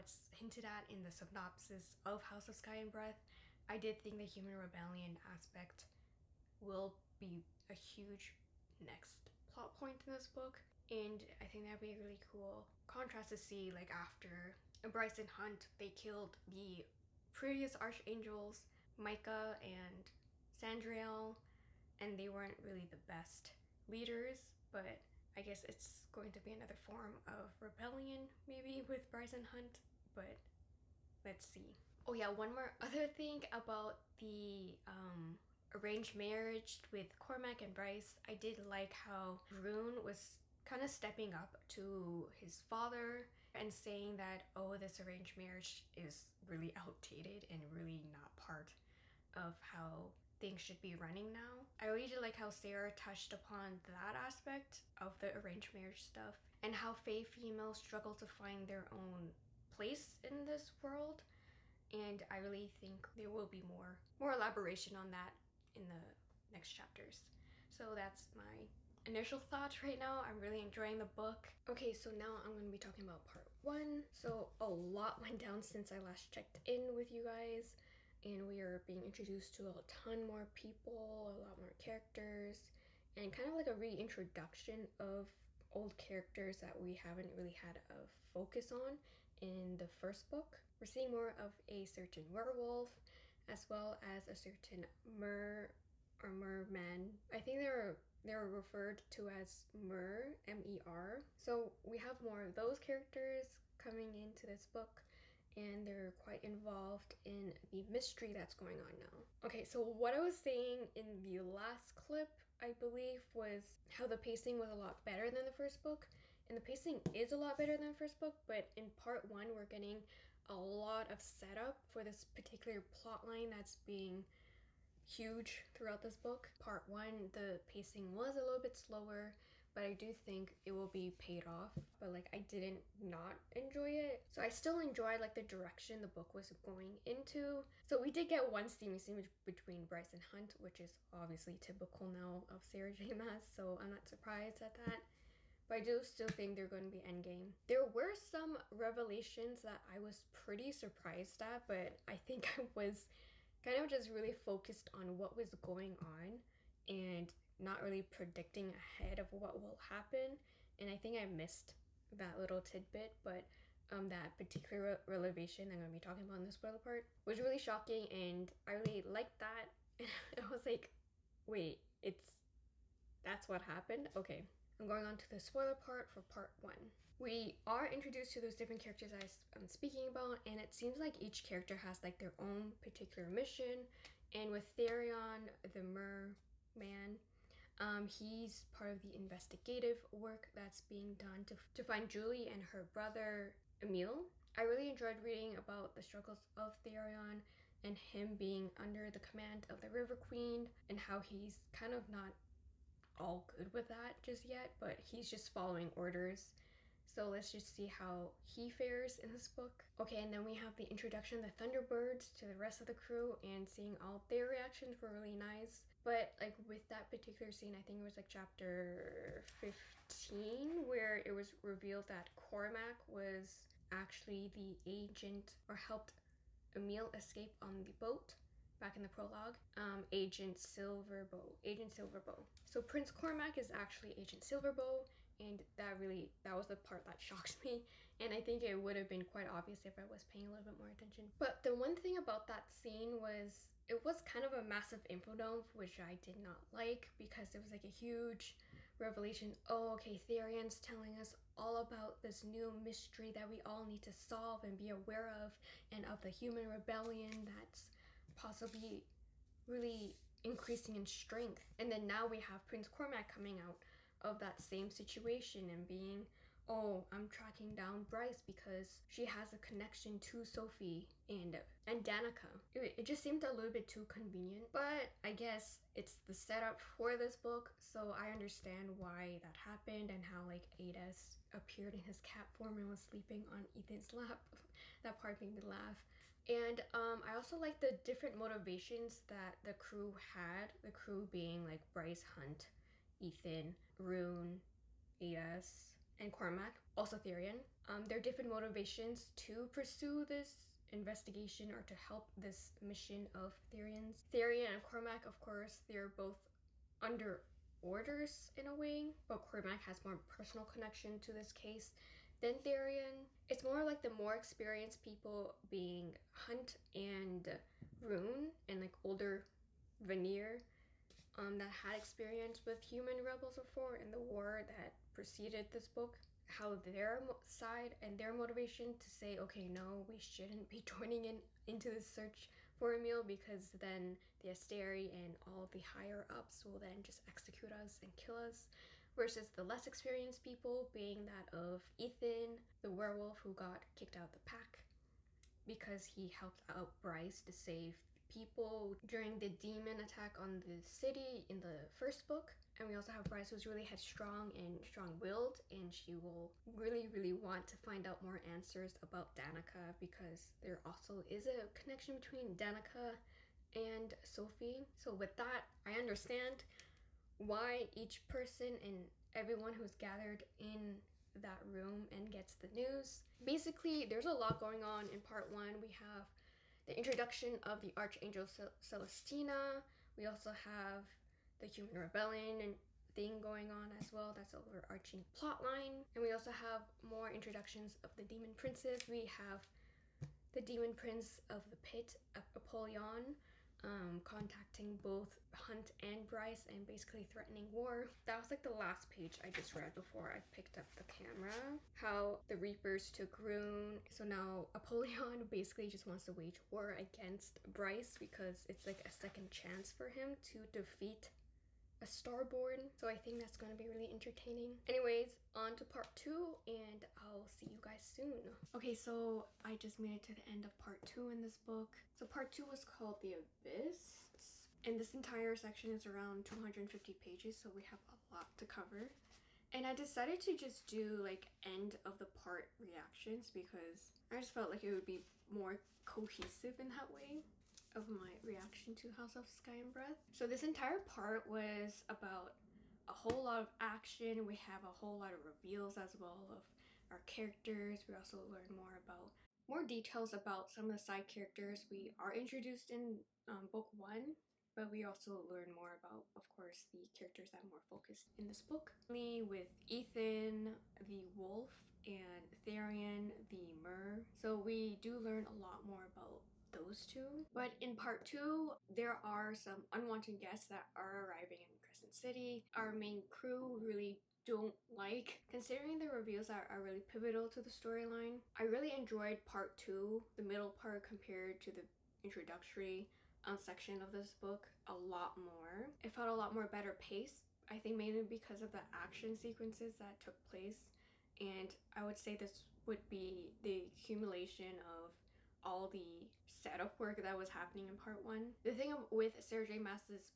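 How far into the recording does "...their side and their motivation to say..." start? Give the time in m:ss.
5:26.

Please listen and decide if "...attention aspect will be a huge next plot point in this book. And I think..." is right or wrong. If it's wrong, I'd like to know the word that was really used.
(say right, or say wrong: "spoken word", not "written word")
wrong: "rebellion", not "attention".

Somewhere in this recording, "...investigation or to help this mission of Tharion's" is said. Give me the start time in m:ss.
5:00.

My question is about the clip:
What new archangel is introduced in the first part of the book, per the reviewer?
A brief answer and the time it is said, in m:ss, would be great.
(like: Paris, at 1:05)
Celestina, at 6:18.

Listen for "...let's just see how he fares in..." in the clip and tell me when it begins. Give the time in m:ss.
3:27.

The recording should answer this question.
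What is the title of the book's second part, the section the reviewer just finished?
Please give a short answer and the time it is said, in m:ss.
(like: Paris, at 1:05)
The Abyss, at 7:03.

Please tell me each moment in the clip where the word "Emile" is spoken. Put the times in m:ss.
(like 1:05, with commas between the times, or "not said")
3:13, 3:46, 5:32.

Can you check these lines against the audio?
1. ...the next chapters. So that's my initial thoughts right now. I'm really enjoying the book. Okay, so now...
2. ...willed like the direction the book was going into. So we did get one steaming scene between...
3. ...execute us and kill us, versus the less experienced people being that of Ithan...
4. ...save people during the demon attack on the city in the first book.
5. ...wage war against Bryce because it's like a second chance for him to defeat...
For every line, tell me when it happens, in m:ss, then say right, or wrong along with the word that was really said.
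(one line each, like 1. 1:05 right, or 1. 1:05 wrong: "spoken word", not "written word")
1. 1:05 right
2. 2:14 wrong: "enjoyed", not "willed"
3. 5:37 right
4. 5:47 right
5. 6:46 right.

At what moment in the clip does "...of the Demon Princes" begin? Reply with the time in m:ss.
6:27.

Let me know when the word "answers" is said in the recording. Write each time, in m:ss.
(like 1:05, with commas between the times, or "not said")
5:58.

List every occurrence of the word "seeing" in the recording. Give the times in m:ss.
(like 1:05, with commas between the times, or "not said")
1:30, 3:33.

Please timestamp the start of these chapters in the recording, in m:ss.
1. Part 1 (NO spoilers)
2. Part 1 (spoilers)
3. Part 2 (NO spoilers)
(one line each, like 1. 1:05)
1. 1:11
2. 2:56
3. 6:57.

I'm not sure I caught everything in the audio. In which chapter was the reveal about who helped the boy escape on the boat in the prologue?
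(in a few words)
Chapter 15.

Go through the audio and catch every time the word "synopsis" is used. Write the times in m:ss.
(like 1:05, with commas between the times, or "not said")
0:01.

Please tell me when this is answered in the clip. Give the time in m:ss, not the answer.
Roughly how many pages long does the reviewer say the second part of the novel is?
7:06.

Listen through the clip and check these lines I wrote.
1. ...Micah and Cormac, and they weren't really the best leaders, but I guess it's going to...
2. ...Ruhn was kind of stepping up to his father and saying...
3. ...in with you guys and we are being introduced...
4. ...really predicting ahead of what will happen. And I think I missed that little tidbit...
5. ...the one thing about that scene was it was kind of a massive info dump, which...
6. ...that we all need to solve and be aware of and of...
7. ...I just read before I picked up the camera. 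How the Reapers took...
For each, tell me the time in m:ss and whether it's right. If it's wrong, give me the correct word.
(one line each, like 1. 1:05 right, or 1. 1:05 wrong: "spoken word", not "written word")
1. 0:18 wrong: "Sandriel", not "Cormac"
2. 0:39 right
3. 1:16 right
4. 2:37 right
5. 4:01 right
6. 4:13 right
7. 6:39 right.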